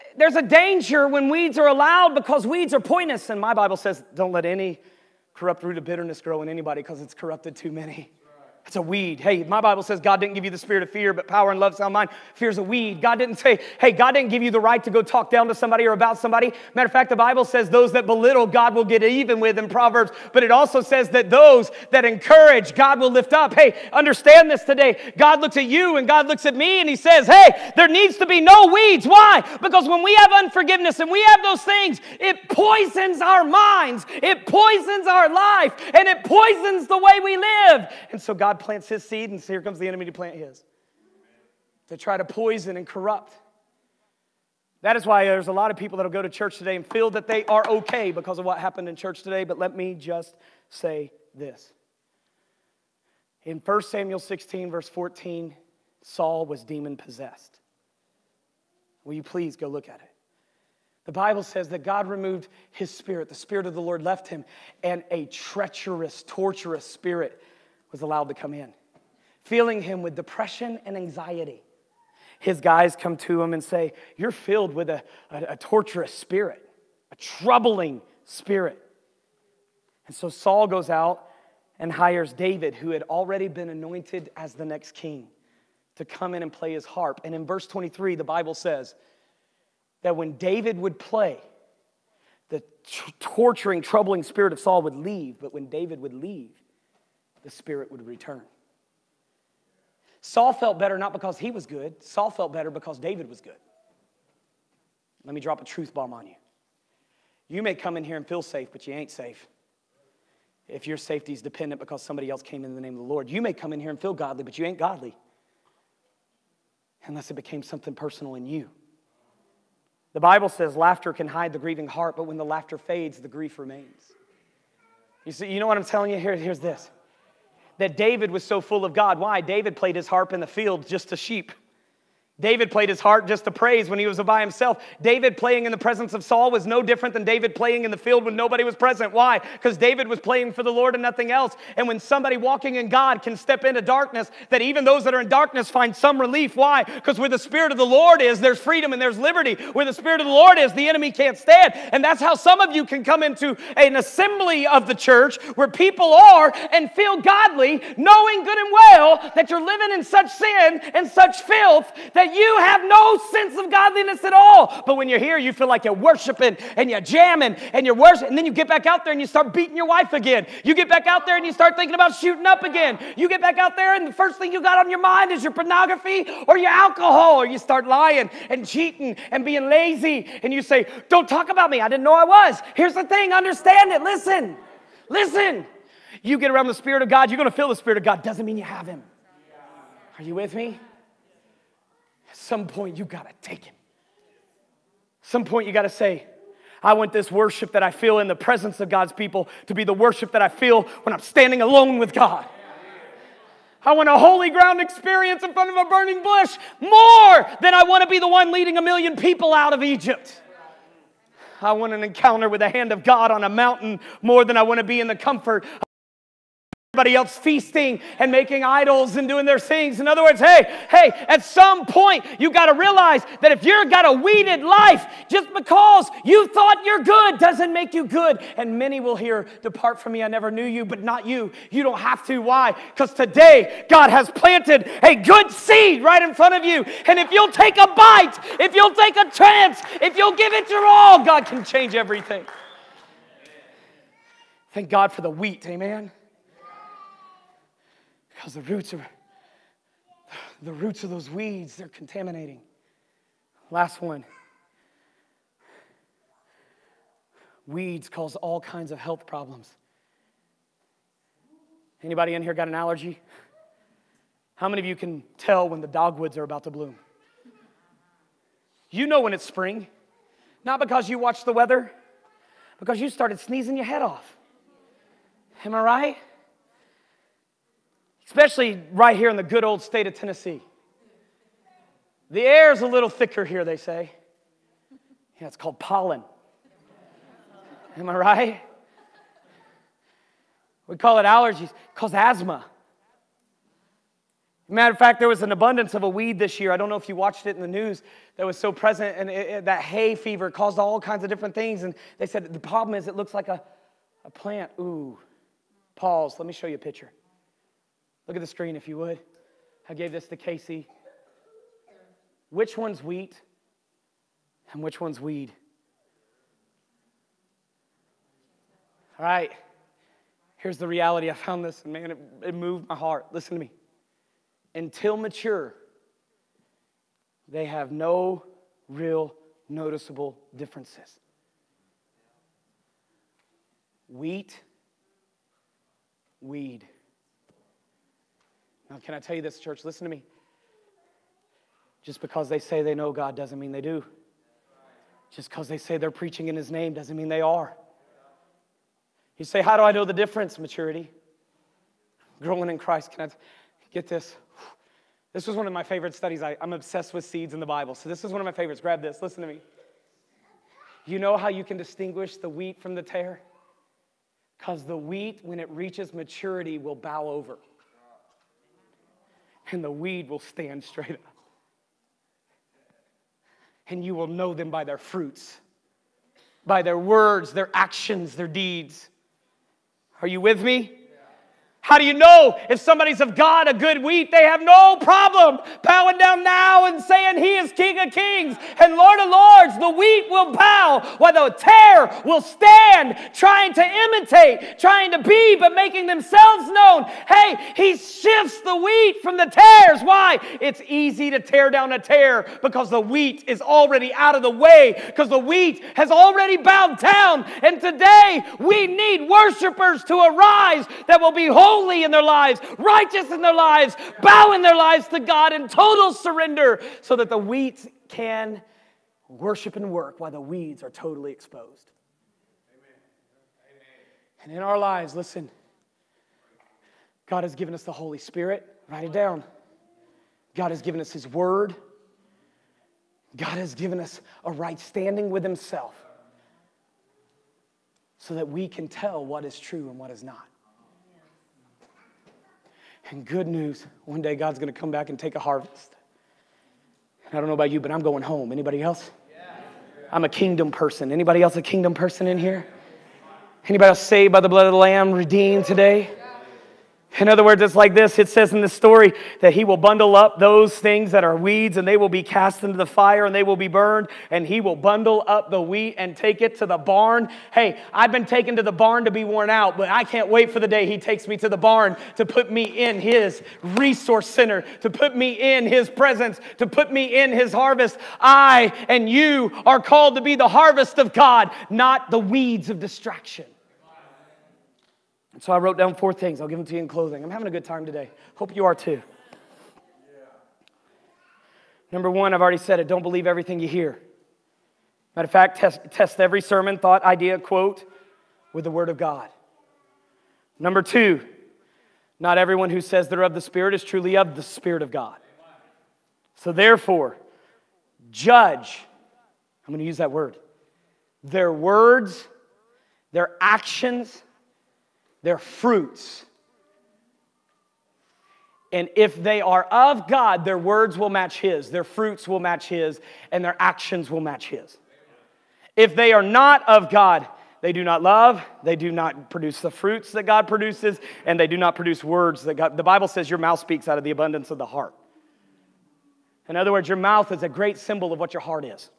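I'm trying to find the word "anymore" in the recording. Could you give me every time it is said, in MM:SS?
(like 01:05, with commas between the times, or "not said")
not said.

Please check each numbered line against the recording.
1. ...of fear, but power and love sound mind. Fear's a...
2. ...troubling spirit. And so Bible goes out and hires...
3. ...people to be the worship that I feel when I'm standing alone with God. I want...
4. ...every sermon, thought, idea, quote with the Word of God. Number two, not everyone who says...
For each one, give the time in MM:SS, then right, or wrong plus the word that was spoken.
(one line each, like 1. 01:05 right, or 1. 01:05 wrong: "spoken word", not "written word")
1. 00:10 right
2. 01:17 wrong: "Saul", not "Bible"
3. 03:19 right
4. 08:16 right.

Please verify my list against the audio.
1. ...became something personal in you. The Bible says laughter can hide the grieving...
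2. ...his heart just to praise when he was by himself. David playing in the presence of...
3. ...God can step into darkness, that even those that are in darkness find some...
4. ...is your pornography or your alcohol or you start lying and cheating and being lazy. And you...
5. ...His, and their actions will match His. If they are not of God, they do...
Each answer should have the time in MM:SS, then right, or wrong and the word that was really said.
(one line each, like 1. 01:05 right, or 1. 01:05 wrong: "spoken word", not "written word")
1. 01:57 right
2. 02:12 right
3. 02:22 right
4. 02:55 right
5. 08:42 right.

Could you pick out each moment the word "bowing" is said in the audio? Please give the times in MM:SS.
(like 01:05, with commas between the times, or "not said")
06:25, 06:54.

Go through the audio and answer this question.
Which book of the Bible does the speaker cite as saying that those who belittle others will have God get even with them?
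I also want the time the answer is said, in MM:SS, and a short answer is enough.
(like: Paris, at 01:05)
Proverbs, at 00:19.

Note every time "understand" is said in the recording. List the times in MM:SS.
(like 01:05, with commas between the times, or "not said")
00:23, 03:03.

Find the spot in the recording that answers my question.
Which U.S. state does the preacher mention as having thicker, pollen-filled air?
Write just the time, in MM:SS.
04:40.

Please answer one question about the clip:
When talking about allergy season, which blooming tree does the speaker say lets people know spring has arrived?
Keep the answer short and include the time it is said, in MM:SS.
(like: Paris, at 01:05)
Dogwoods, at 04:25.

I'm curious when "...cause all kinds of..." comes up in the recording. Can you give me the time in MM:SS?
04:18.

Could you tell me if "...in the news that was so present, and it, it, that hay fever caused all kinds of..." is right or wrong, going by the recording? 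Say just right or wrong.
right.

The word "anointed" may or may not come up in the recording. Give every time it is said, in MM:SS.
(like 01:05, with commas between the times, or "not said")
01:23.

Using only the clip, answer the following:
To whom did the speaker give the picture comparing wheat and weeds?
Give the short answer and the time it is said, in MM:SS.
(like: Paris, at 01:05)
Casey, at 05:10.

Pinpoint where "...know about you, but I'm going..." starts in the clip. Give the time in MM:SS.
07:27.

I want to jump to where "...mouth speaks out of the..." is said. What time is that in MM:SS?
08:53.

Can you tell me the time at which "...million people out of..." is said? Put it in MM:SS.
03:28.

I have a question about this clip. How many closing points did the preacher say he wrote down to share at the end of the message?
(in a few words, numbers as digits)
4.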